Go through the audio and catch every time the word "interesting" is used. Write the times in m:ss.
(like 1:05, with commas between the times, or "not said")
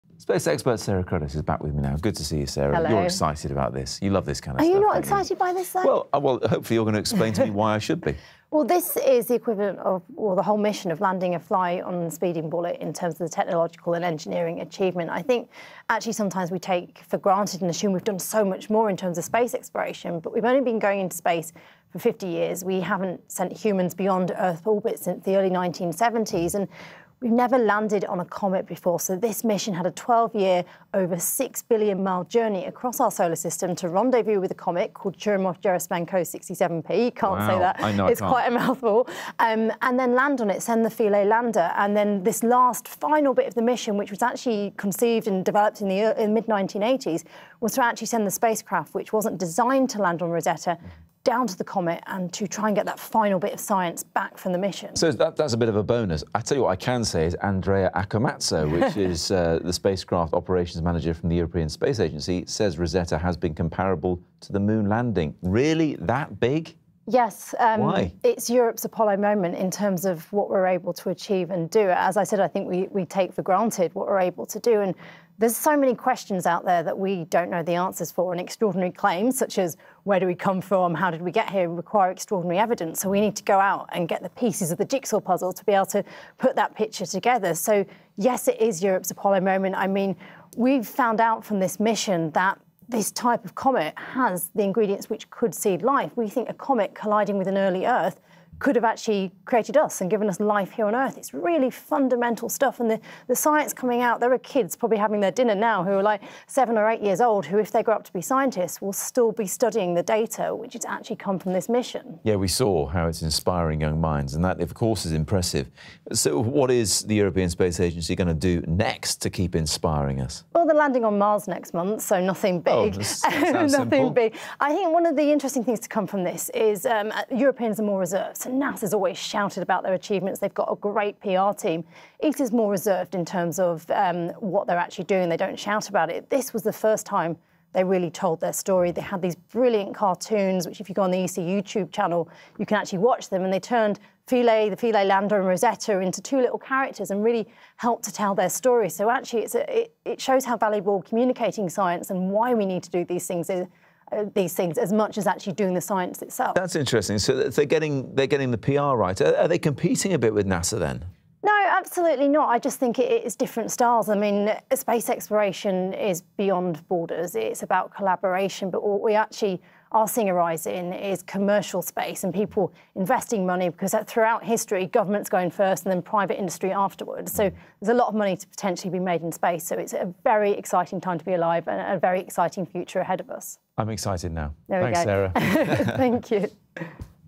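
2:05, 2:36.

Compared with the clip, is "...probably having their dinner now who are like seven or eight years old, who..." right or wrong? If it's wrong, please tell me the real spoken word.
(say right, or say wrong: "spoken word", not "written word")
right.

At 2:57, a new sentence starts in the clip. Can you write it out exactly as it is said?
So there's a lot of money to potentially be made in space.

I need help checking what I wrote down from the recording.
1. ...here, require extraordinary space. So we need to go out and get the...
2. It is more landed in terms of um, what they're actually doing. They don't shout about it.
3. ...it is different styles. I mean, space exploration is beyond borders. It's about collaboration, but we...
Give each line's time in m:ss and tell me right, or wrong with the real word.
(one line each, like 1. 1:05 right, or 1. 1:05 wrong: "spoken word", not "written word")
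1. 1:21 wrong: "evidence", not "space"
2. 2:12 wrong: "reserved", not "landed"
3. 2:42 right.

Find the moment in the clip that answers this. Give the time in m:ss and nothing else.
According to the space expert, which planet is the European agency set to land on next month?
2:01.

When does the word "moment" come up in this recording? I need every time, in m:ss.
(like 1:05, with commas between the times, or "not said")
1:09, 1:29.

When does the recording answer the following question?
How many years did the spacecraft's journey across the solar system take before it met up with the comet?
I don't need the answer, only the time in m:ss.
0:29.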